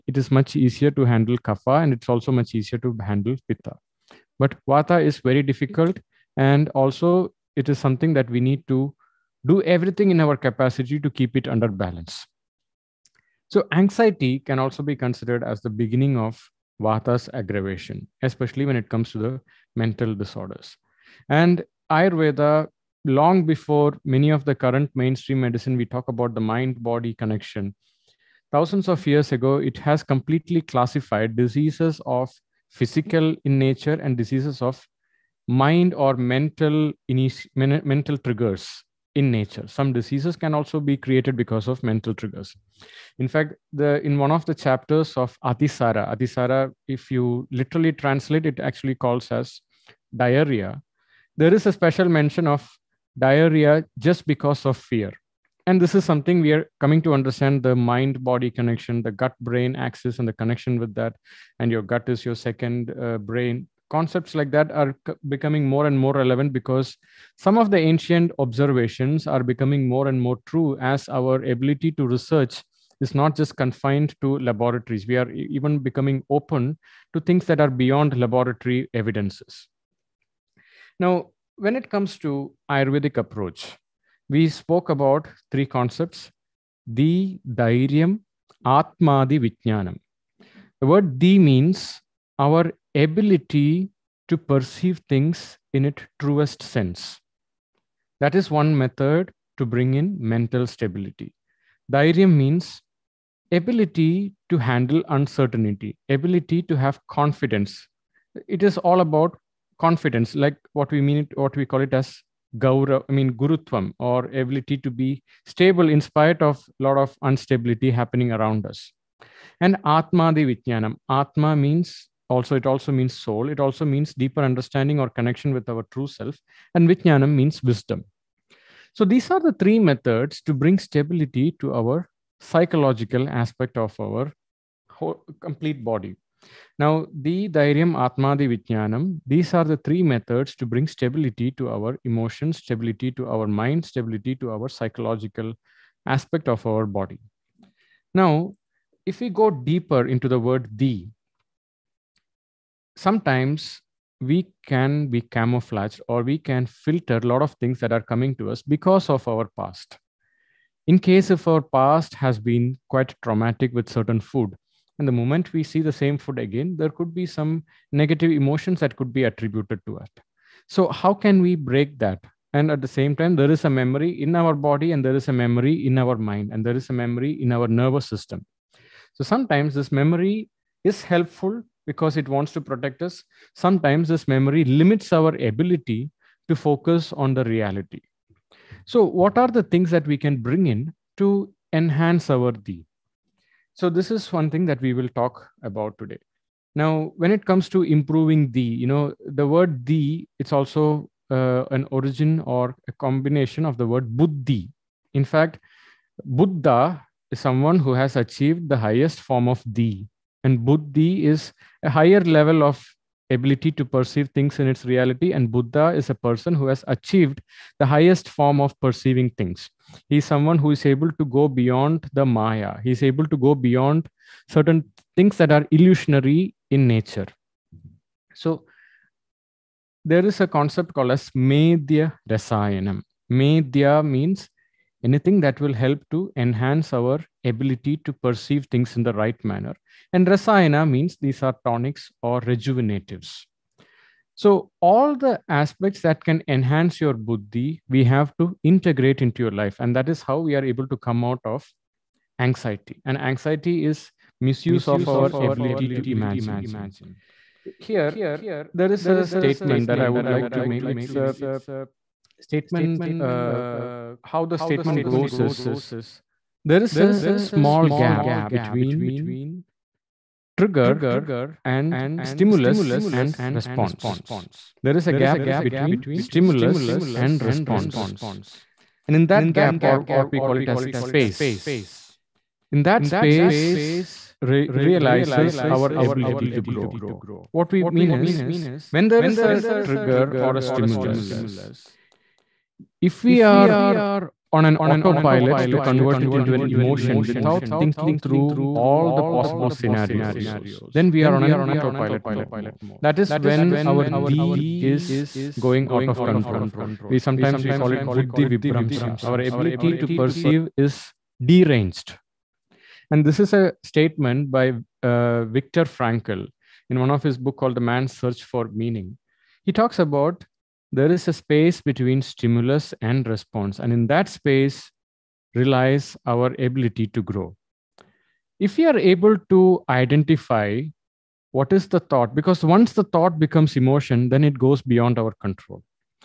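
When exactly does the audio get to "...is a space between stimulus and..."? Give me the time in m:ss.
5:21.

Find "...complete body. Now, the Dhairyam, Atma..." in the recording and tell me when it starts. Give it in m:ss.
2:15.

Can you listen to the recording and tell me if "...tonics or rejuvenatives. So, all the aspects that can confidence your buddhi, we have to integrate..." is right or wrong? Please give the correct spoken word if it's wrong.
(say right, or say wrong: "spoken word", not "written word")
wrong: "enhance", not "confidence".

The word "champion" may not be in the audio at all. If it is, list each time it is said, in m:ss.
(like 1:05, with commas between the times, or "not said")
not said.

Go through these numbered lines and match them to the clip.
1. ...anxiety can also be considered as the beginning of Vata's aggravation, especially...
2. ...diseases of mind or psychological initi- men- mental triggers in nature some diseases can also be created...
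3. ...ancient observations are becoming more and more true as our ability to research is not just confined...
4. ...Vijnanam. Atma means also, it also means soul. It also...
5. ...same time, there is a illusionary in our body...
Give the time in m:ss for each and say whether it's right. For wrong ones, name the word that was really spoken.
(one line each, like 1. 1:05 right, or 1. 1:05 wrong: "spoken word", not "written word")
1. 0:13 right
2. 0:34 wrong: "mental", not "psychological"
3. 1:07 right
4. 2:00 right
5. 2:52 wrong: "memory", not "illusionary".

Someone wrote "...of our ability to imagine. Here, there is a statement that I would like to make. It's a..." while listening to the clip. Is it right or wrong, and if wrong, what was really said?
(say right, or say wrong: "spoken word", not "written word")
right.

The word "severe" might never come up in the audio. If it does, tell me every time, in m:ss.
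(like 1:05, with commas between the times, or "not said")
not said.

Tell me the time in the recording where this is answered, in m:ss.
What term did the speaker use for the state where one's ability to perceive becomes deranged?
5:08.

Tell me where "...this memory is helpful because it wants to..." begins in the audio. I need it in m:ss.
2:59.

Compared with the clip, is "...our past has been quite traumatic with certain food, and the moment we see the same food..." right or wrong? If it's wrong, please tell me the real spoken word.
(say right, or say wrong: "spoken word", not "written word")
right.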